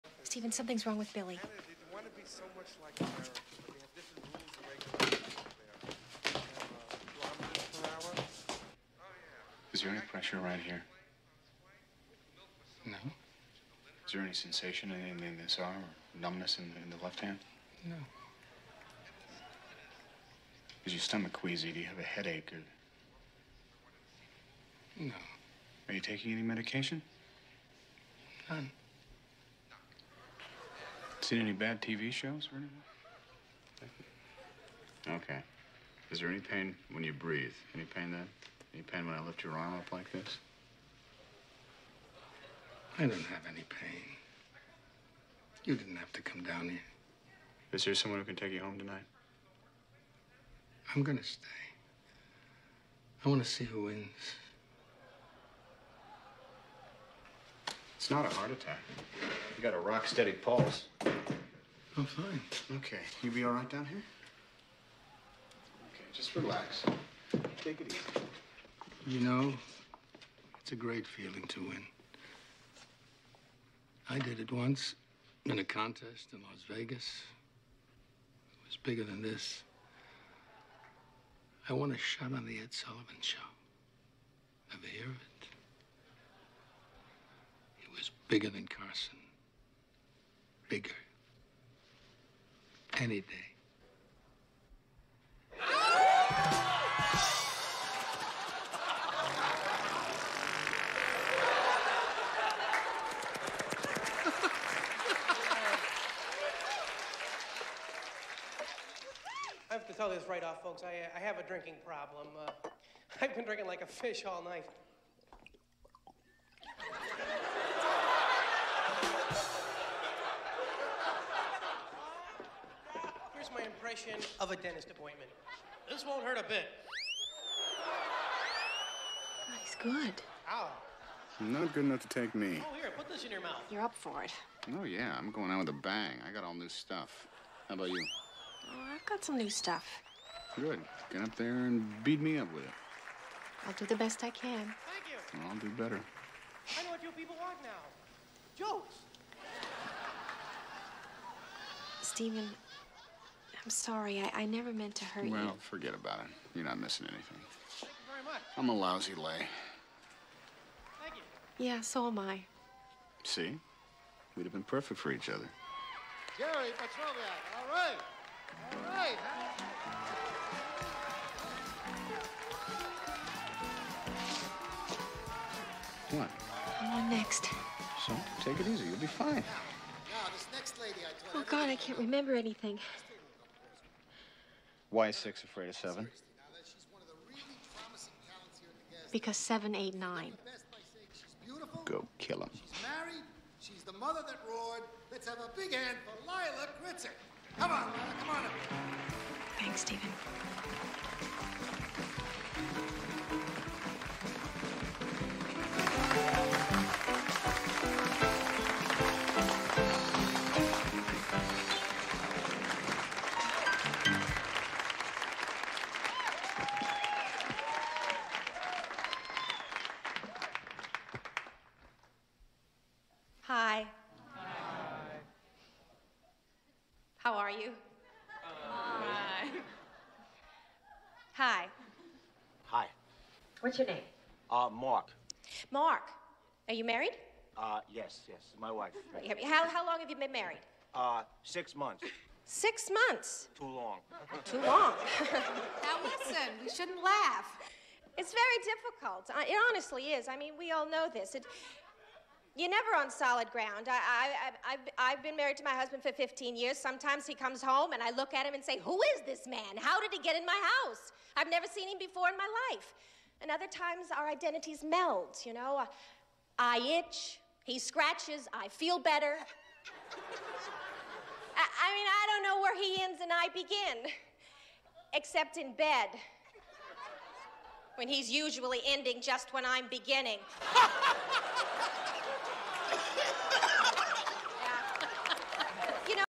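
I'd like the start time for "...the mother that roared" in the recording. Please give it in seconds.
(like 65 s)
193 s.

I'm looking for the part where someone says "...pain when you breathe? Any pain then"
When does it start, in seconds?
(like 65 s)
36 s.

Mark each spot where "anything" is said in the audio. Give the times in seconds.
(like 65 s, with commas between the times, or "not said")
32 s, 157 s, 182 s.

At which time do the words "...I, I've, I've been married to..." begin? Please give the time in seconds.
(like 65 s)
254 s.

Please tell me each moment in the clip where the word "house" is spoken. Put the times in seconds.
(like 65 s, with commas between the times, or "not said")
260 s.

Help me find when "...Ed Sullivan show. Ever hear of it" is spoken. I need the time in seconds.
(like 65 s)
82 s.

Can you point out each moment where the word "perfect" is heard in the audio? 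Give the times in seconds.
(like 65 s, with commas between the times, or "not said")
164 s.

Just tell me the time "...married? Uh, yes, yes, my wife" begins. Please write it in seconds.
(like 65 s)
236 s.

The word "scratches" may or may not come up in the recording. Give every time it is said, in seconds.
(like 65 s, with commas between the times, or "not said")
267 s.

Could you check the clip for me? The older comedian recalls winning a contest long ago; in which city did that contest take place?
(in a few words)
Las Vegas.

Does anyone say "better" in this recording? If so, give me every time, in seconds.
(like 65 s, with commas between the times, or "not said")
145 s, 268 s.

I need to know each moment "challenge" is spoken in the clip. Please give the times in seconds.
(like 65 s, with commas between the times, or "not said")
not said.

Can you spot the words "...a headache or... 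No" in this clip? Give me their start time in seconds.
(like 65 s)
21 s.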